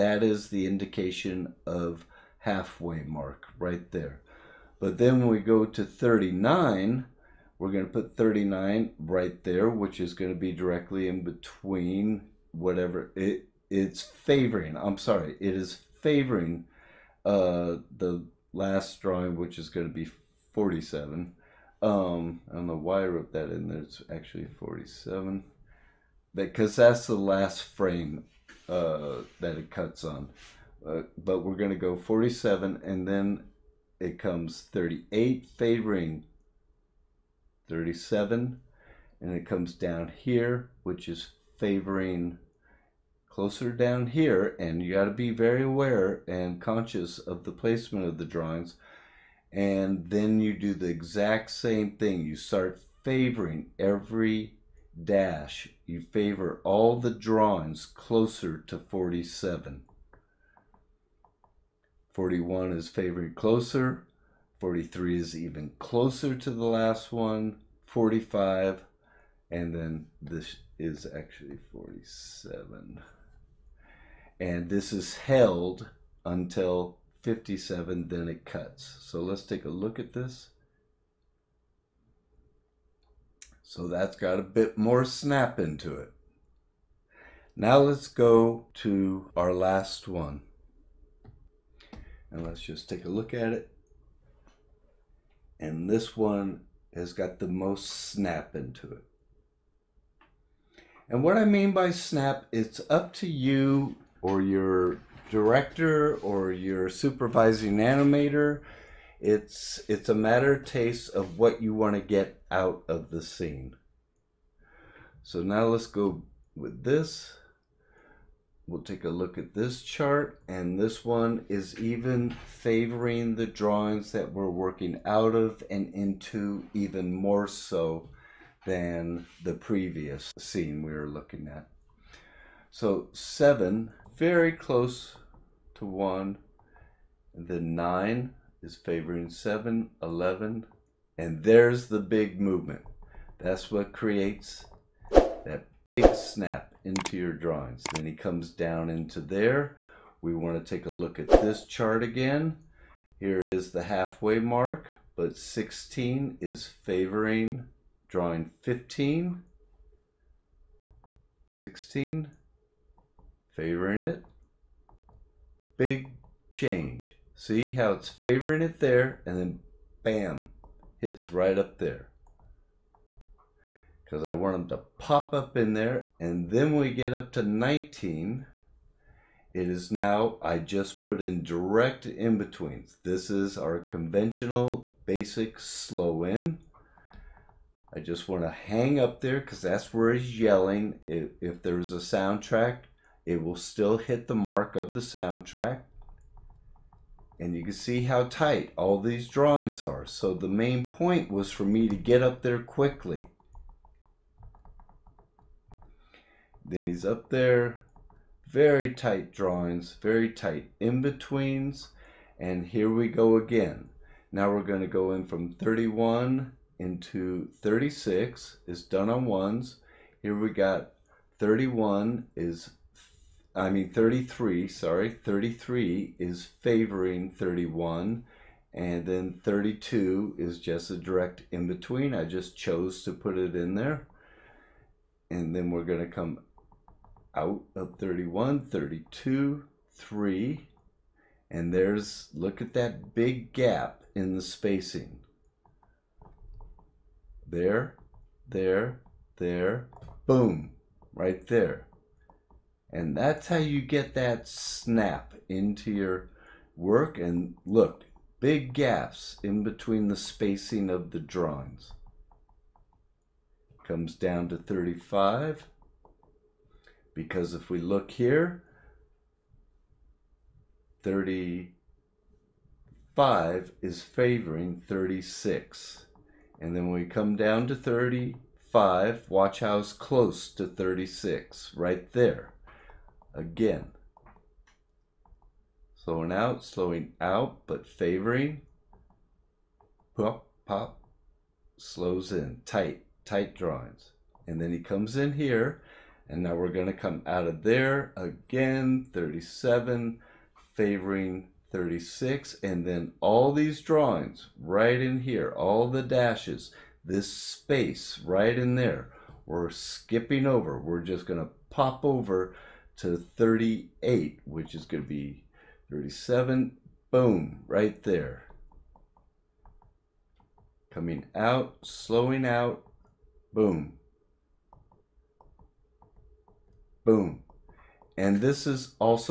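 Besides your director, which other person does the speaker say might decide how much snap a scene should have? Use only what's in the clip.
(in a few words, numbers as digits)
Supervising animator.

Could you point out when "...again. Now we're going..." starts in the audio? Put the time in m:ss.
3:33.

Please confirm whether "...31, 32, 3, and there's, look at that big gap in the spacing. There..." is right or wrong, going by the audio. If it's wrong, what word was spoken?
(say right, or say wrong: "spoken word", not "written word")
right.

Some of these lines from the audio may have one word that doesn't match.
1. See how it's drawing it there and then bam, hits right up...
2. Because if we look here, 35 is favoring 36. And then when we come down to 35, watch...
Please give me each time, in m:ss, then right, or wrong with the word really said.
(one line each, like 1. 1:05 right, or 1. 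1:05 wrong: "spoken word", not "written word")
1. 2:47 wrong: "favoring", not "drawing"
2. 4:27 right.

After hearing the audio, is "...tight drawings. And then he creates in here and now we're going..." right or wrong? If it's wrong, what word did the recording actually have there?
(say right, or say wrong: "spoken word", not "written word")
wrong: "comes", not "creates".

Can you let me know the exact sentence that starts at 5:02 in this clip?
And then all these drawings right in here, all the dashes, this space right in there, we're skipping over.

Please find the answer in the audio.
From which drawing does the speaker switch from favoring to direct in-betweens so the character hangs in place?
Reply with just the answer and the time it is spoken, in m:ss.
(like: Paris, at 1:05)
19, at 2:57.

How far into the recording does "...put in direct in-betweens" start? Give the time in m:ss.
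3:01.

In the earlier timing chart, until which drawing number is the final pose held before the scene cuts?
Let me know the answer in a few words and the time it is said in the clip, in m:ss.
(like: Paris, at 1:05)
57, at 1:17.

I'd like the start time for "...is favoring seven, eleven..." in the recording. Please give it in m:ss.
2:18.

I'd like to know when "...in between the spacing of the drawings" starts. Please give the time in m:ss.
4:19.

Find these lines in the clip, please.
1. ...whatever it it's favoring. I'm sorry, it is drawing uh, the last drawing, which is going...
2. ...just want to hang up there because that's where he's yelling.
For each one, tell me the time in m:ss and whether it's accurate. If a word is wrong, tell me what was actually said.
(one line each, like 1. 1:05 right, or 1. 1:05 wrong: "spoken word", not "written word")
1. 0:12 wrong: "favoring", not "drawing"
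2. 3:07 right.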